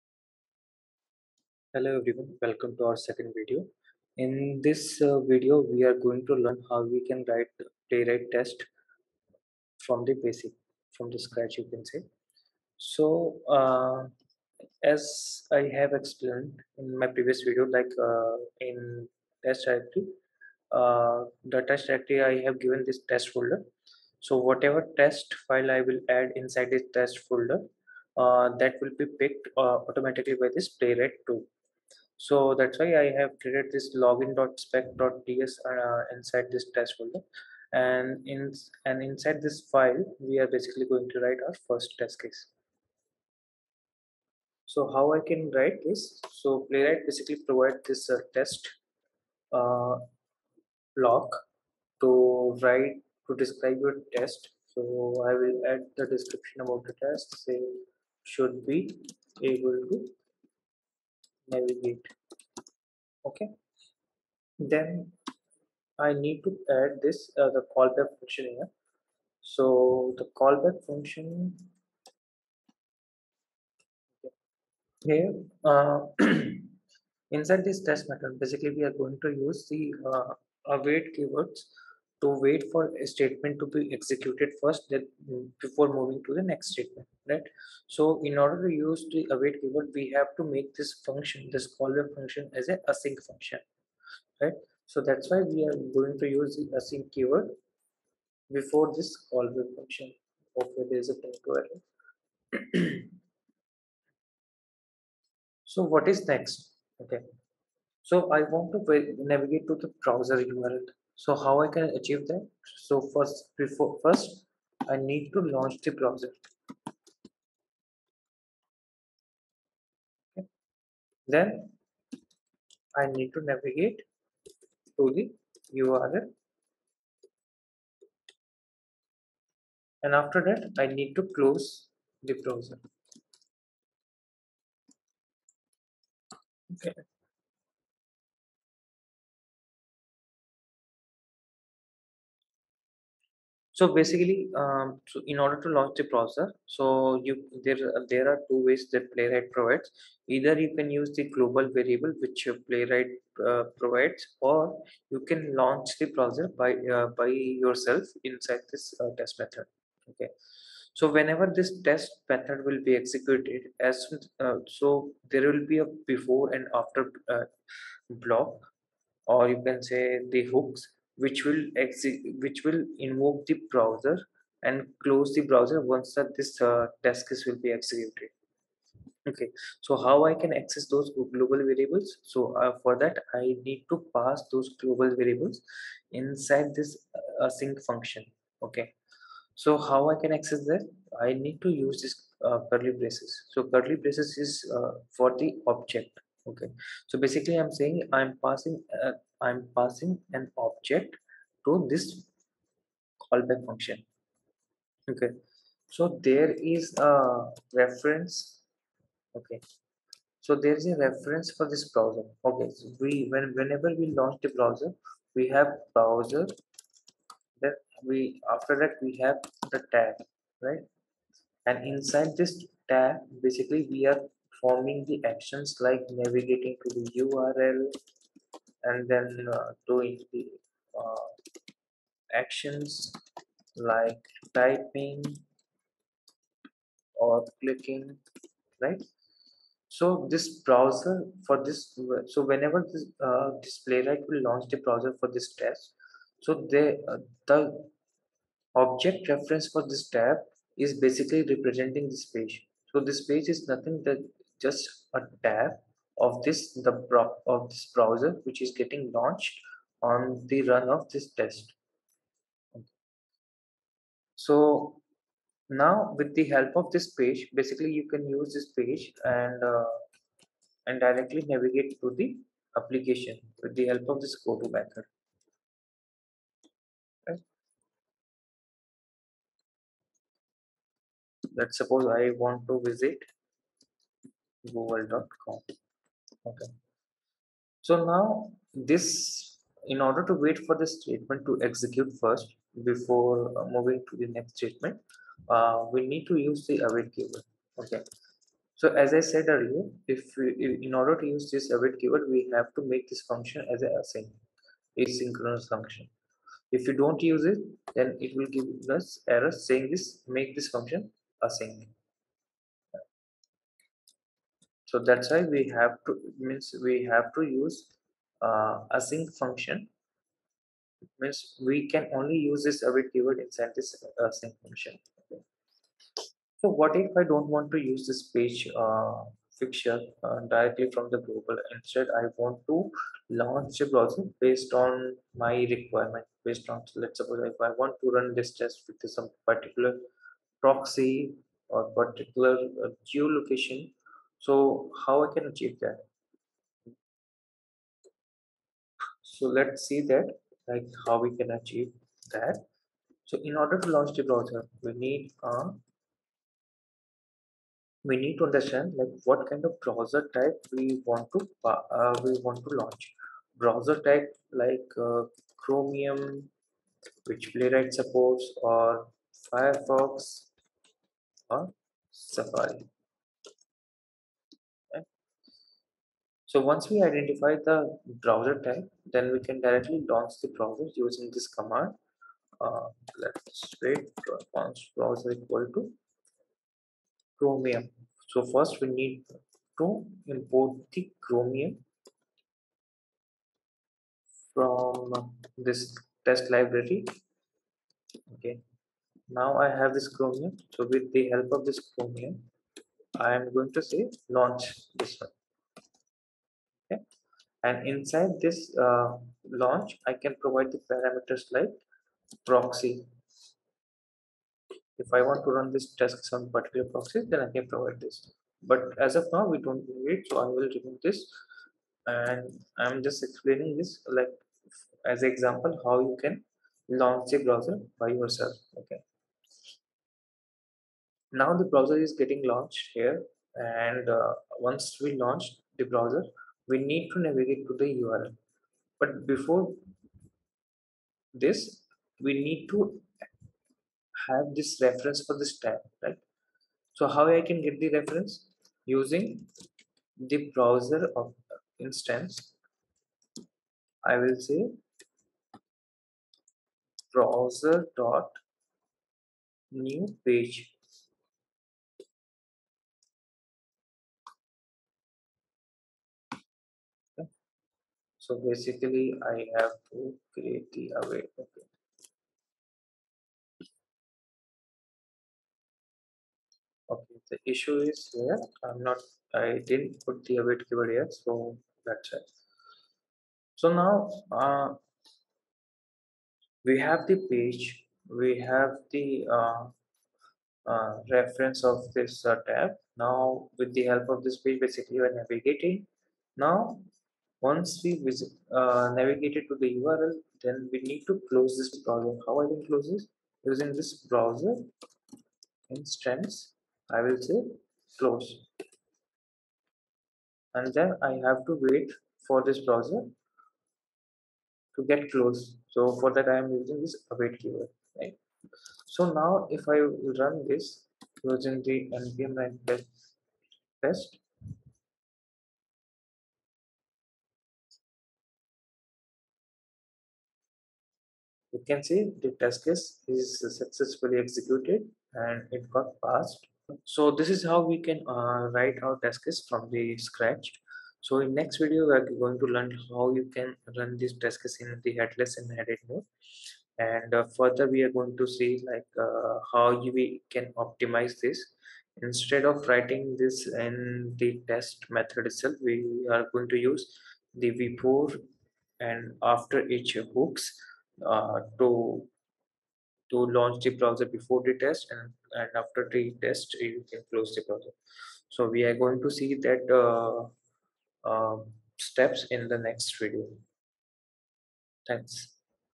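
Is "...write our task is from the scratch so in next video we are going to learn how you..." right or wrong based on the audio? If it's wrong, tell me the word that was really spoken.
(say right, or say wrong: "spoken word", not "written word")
right.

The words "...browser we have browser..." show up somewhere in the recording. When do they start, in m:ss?
3:34.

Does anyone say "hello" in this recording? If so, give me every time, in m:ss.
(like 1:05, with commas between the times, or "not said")
0:01.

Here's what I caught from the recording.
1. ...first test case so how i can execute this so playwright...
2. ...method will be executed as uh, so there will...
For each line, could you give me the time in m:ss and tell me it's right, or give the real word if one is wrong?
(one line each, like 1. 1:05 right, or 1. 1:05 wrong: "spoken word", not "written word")
1. 0:41 wrong: "write", not "execute"
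2. 2:42 right.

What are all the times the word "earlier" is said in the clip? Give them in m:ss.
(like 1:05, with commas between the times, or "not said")
4:59.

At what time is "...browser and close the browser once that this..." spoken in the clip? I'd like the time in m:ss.
2:53.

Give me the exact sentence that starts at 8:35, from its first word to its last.
So for that, I am using this await keyword, right?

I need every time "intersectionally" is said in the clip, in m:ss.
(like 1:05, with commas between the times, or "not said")
not said.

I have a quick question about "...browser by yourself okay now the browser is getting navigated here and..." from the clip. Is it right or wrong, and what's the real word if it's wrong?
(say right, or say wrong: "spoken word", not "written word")
wrong: "launched", not "navigated".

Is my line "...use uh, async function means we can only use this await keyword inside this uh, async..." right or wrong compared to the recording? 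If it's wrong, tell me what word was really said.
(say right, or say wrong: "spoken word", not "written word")
right.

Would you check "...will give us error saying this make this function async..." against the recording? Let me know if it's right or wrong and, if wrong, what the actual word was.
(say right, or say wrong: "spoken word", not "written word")
right.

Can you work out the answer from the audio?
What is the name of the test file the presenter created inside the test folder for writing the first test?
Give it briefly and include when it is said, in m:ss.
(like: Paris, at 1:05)
login.spec.ts, at 0:34.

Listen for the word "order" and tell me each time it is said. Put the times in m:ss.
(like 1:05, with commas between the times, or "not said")
1:28, 2:25, 4:50, 5:00, 5:53.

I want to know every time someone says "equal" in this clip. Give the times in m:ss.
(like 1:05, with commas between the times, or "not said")
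6:25.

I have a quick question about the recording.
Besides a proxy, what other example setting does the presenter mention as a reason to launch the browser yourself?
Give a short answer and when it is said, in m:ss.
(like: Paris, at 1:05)
geolocation, at 5:43.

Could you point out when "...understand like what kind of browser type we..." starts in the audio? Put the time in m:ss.
5:58.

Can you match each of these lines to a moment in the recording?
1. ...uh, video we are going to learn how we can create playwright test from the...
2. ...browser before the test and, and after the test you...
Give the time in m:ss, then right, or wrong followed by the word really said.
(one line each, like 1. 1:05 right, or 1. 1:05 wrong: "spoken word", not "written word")
1. 0:05 wrong: "write", not "create"
2. 9:23 right.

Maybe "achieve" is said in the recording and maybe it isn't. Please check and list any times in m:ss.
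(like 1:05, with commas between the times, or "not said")
1:51, 5:45, 5:51.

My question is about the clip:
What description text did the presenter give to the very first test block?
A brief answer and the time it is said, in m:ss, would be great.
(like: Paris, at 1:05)
should be able to navigate, at 0:58.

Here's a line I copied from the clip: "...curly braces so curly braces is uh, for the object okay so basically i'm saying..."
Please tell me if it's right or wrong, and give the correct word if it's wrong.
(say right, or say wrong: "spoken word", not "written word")
right.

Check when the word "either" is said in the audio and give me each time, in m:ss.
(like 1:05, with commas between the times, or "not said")
2:30.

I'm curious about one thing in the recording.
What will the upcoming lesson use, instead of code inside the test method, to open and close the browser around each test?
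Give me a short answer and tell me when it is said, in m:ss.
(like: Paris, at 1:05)
before and after each hooks, at 9:17.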